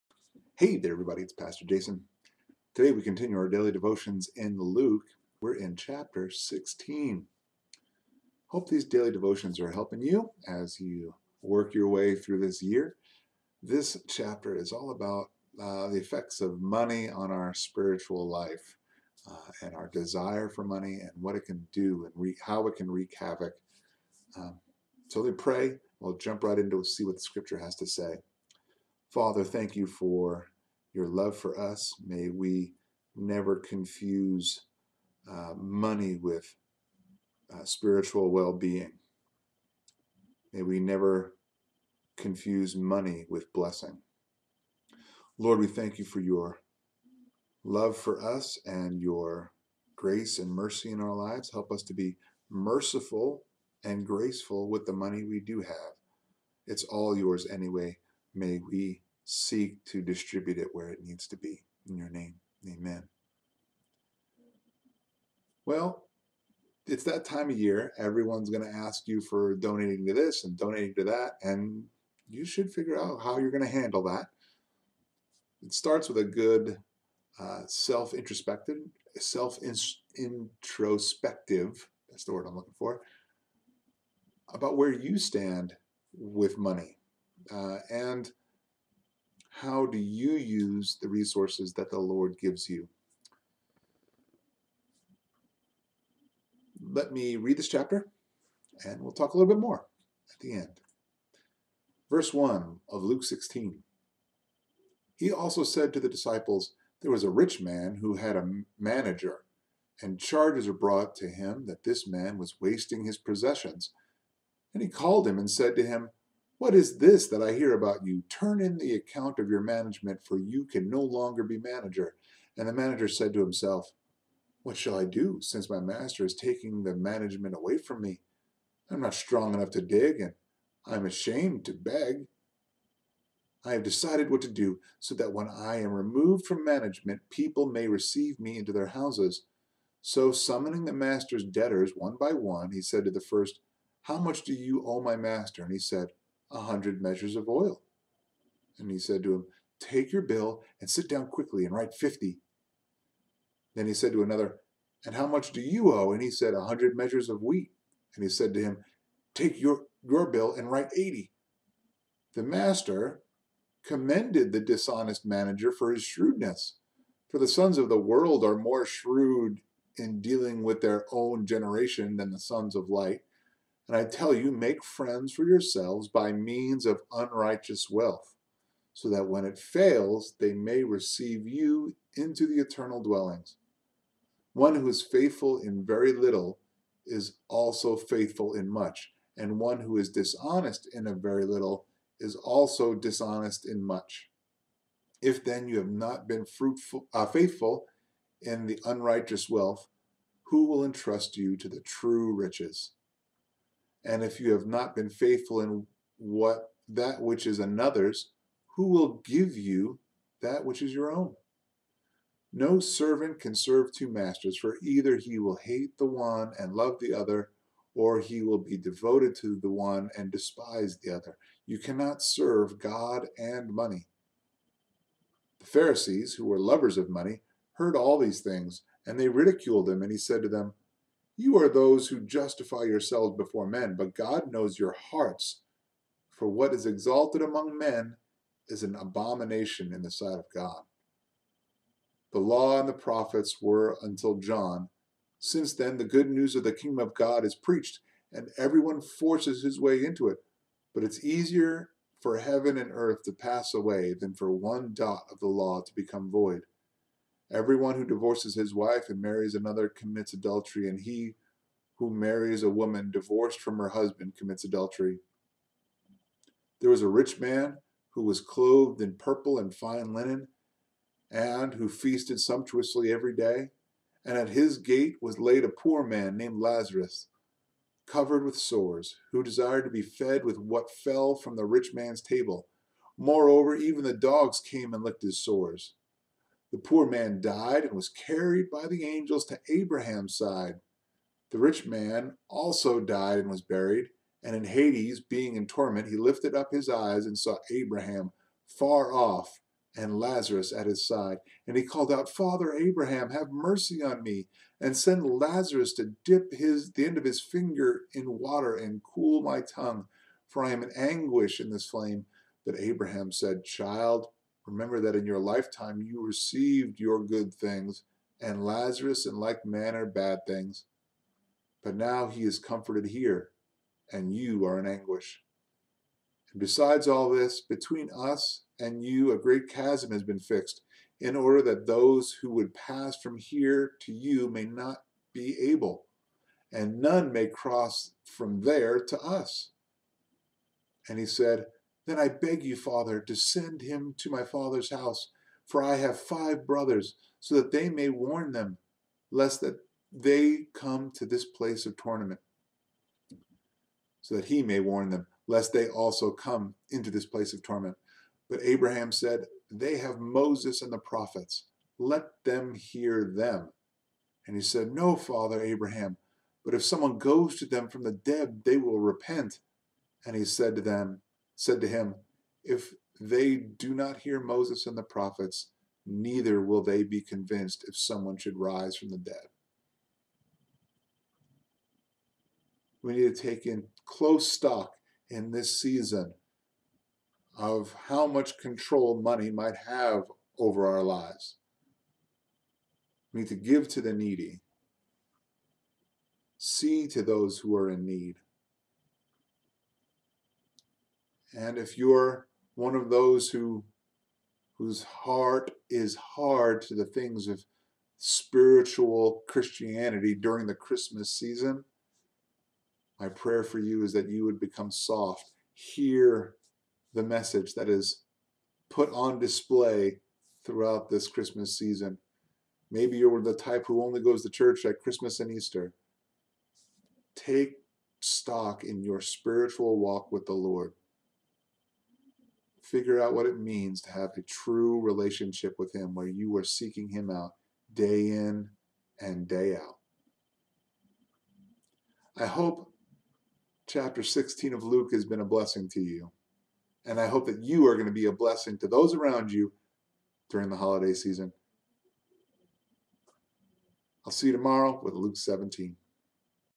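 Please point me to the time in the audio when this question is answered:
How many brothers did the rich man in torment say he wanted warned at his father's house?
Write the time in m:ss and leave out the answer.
5:46.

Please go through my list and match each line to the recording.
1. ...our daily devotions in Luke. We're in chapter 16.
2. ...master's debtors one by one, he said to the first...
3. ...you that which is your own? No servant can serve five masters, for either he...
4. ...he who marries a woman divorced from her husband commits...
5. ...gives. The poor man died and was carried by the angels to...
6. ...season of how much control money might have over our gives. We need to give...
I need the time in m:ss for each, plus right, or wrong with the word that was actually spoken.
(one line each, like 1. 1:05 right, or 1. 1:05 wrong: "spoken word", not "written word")
1. 0:03 right
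2. 2:20 right
3. 3:29 wrong: "two", not "five"
4. 4:21 right
5. 4:45 wrong: "sores", not "gives"
6. 6:25 wrong: "lives", not "gives".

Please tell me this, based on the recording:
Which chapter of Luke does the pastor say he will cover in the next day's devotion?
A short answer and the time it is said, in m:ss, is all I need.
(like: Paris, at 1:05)
Luke 17, at 7:35.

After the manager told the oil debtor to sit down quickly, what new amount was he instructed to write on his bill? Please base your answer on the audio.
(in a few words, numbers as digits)
50.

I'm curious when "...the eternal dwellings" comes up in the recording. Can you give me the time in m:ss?
3:02.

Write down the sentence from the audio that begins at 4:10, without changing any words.
But it's easier for heaven and earth to pass away than for one dot of the law to become void.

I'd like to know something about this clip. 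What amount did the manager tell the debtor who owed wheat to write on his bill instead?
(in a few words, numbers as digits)
80.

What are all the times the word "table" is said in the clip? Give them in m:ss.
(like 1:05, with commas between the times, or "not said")
4:42.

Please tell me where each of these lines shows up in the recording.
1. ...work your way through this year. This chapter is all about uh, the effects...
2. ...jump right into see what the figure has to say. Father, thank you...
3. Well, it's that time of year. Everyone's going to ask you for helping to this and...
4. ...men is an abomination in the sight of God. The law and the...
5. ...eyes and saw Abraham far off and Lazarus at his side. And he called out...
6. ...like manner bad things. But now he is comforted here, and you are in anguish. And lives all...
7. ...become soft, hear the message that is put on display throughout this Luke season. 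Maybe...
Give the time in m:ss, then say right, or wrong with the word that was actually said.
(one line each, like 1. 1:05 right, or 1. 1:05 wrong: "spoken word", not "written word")
1. 0:11 right
2. 0:26 wrong: "scripture", not "figure"
3. 1:05 wrong: "donating", not "helping"
4. 3:57 right
5. 4:56 right
6. 5:19 wrong: "besides", not "lives"
7. 6:54 wrong: "Christmas", not "Luke".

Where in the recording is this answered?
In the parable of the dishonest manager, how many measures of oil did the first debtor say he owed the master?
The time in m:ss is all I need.
2:26.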